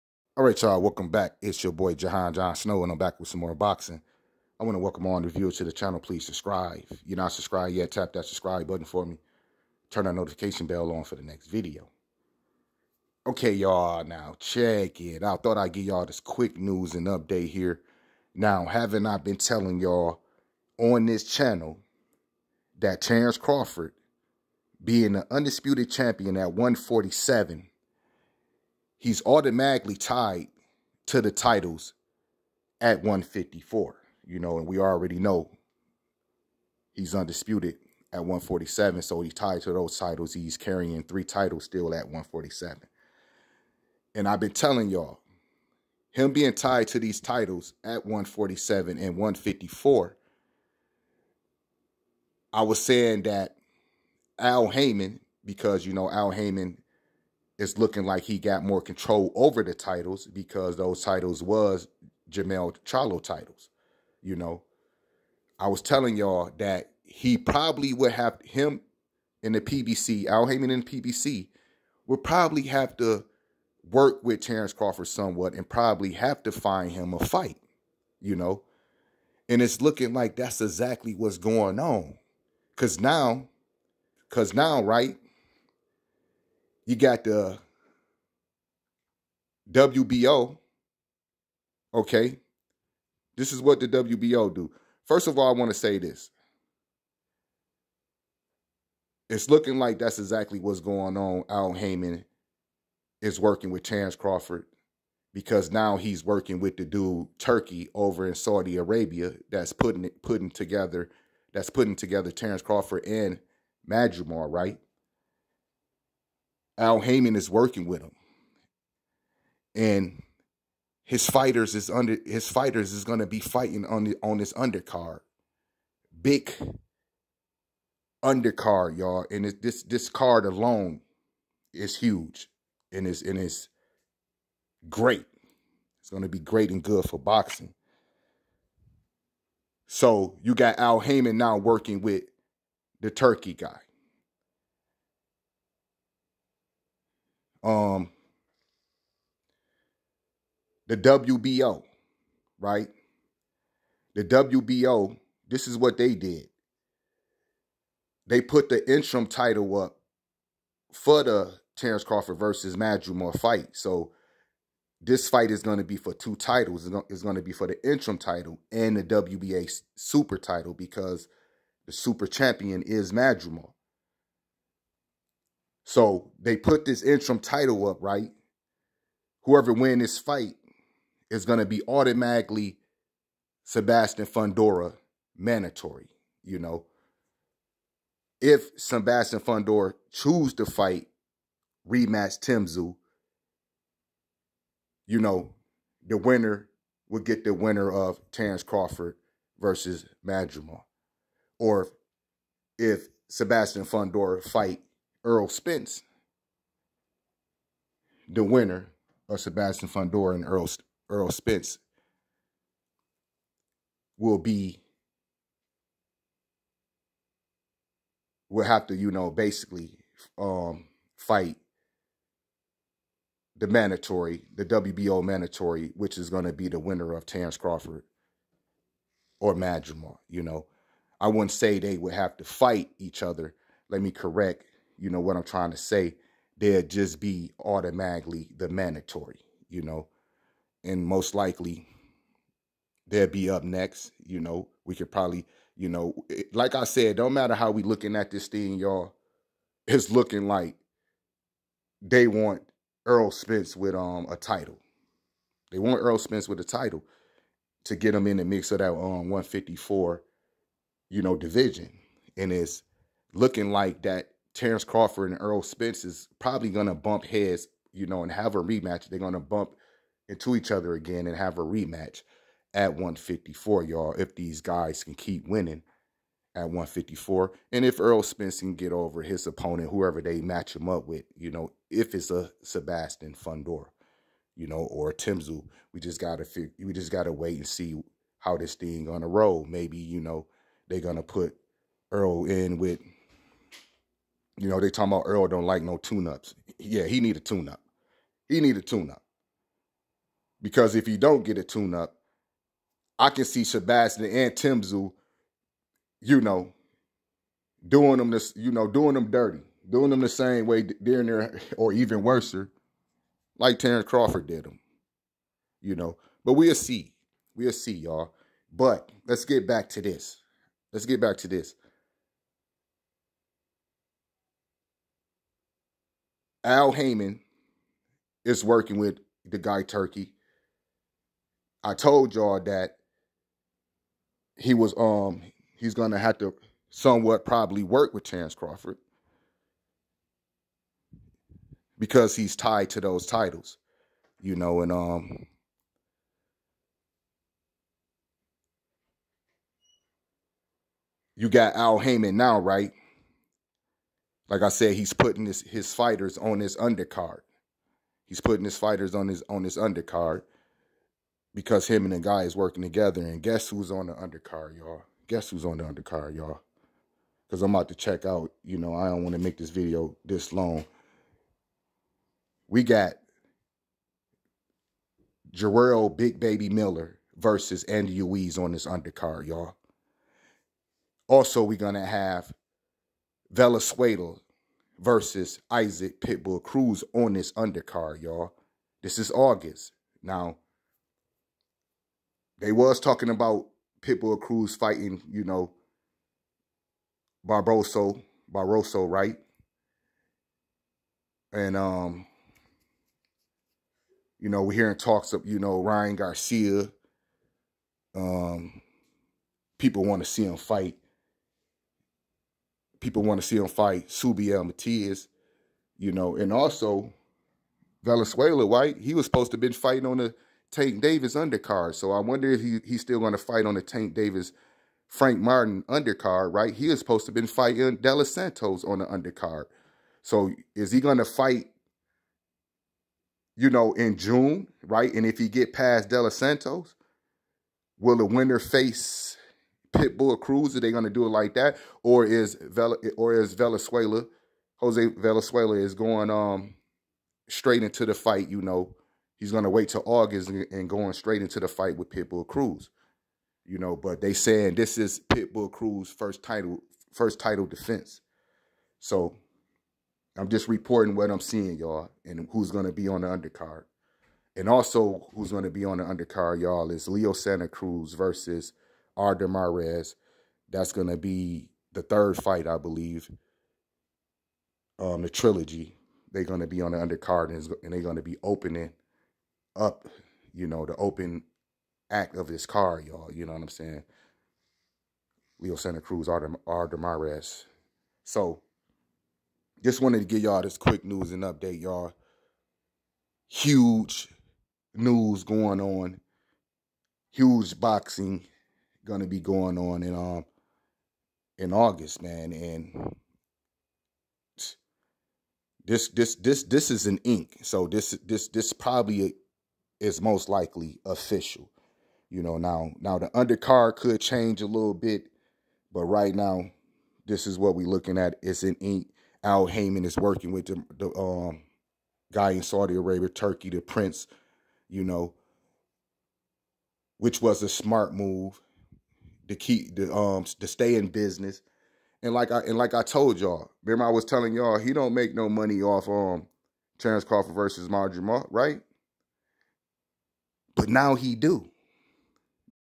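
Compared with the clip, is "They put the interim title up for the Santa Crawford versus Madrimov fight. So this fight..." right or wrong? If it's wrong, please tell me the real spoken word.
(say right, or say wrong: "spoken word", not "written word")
wrong: "Terence", not "Santa".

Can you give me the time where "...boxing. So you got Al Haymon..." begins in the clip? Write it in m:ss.
2:17.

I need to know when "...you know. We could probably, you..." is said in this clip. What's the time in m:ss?
4:04.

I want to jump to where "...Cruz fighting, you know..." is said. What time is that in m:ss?
6:34.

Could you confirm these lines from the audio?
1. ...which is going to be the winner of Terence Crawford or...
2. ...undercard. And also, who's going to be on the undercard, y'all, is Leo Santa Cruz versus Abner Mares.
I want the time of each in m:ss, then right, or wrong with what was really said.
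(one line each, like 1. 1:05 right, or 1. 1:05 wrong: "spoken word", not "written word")
1. 3:45 right
2. 7:43 right.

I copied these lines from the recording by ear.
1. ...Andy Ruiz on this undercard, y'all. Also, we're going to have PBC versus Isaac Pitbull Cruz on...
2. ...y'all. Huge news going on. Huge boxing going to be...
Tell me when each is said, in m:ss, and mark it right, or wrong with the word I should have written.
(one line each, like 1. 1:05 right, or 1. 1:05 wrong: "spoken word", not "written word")
1. 6:17 wrong: "Valenzuela", not "PBC"
2. 8:11 right.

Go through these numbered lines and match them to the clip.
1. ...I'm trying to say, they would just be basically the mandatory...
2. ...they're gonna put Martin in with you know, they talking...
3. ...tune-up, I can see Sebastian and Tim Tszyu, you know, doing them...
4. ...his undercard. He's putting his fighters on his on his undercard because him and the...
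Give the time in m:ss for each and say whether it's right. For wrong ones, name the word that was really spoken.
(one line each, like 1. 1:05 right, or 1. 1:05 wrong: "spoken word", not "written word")
1. 3:55 wrong: "automatically", not "basically"
2. 4:50 wrong: "Errol", not "Martin"
3. 5:01 right
4. 5:56 right.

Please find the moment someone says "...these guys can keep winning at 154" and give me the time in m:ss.
4:34.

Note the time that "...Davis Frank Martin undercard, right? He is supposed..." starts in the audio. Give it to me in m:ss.
7:04.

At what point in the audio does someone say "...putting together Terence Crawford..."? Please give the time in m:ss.
1:51.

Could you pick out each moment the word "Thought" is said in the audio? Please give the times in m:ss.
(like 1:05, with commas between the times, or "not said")
0:15.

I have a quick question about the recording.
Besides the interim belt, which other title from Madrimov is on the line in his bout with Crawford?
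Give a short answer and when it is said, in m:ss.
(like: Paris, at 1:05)
WBA super title, at 2:49.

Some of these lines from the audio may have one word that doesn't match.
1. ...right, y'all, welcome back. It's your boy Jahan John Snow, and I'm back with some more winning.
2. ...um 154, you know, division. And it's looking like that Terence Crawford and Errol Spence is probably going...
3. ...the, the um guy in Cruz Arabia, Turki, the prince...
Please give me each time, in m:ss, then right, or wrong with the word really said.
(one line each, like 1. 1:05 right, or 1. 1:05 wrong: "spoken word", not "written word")
1. 0:00 wrong: "boxing", not "winning"
2. 4:18 right
3. 8:40 wrong: "Saudi", not "Cruz".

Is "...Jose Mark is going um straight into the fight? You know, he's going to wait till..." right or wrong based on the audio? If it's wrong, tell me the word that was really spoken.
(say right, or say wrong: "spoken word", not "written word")
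wrong: "Valenzuela", not "Mark".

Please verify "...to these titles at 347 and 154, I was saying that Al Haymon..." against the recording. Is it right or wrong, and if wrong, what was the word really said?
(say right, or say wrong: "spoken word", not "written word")
wrong: "147", not "347".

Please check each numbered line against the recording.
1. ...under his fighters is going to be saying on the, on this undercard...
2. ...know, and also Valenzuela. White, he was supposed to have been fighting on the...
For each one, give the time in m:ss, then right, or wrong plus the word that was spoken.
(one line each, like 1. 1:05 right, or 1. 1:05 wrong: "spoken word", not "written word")
1. 2:01 wrong: "fighting", not "saying"
2. 6:56 right.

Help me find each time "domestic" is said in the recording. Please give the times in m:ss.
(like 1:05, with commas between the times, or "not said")
not said.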